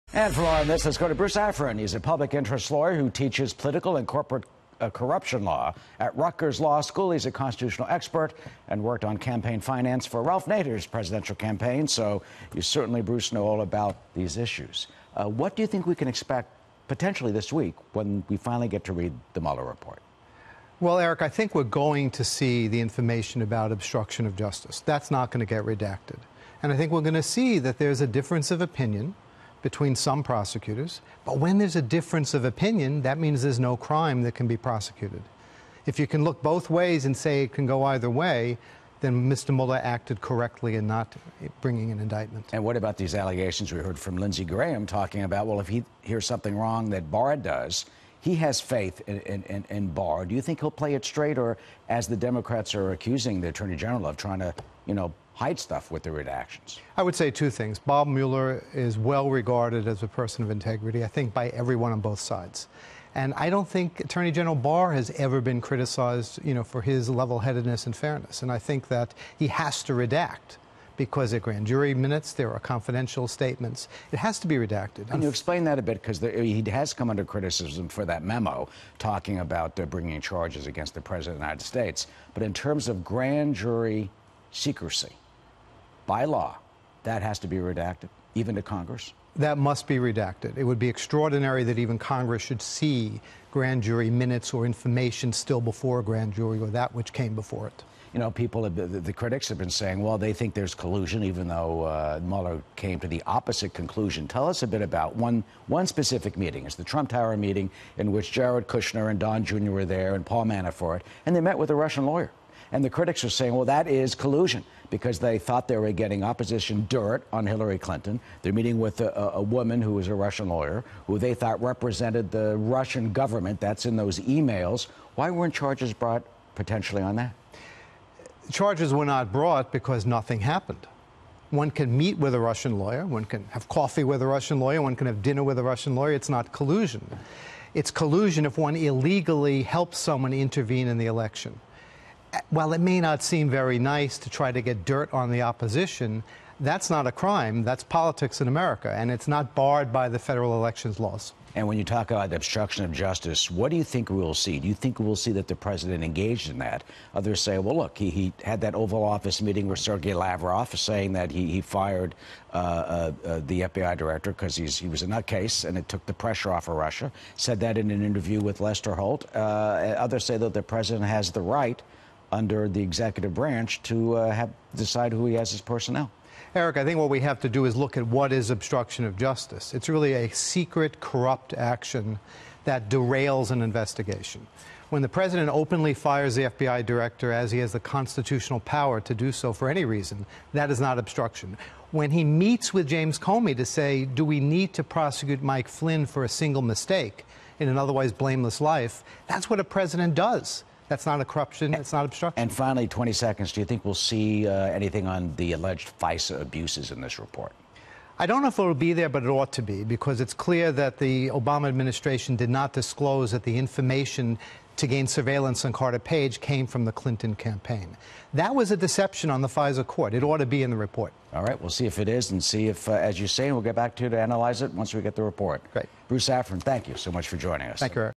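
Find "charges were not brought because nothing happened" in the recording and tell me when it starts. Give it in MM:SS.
02:08.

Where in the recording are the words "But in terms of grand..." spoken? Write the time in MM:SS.
01:22.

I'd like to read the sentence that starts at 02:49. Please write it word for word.
Uh, others say that the president has the right under the executive branch to uh, have, decide who he has as personnel.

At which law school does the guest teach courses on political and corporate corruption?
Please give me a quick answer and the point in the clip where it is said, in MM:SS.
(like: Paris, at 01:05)
Rutgers Law School, at 00:06.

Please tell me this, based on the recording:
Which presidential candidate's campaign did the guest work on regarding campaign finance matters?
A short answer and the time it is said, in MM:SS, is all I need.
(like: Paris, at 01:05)
Ralph Nader, at 00:10.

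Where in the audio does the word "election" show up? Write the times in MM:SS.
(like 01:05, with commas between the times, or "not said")
02:21, 02:30.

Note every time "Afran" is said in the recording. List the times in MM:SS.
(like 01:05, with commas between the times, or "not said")
00:01, 03:46.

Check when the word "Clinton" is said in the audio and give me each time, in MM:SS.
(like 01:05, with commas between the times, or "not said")
01:57, 03:36.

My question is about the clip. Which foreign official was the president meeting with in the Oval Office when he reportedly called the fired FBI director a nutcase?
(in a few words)
Sergei Lavrov.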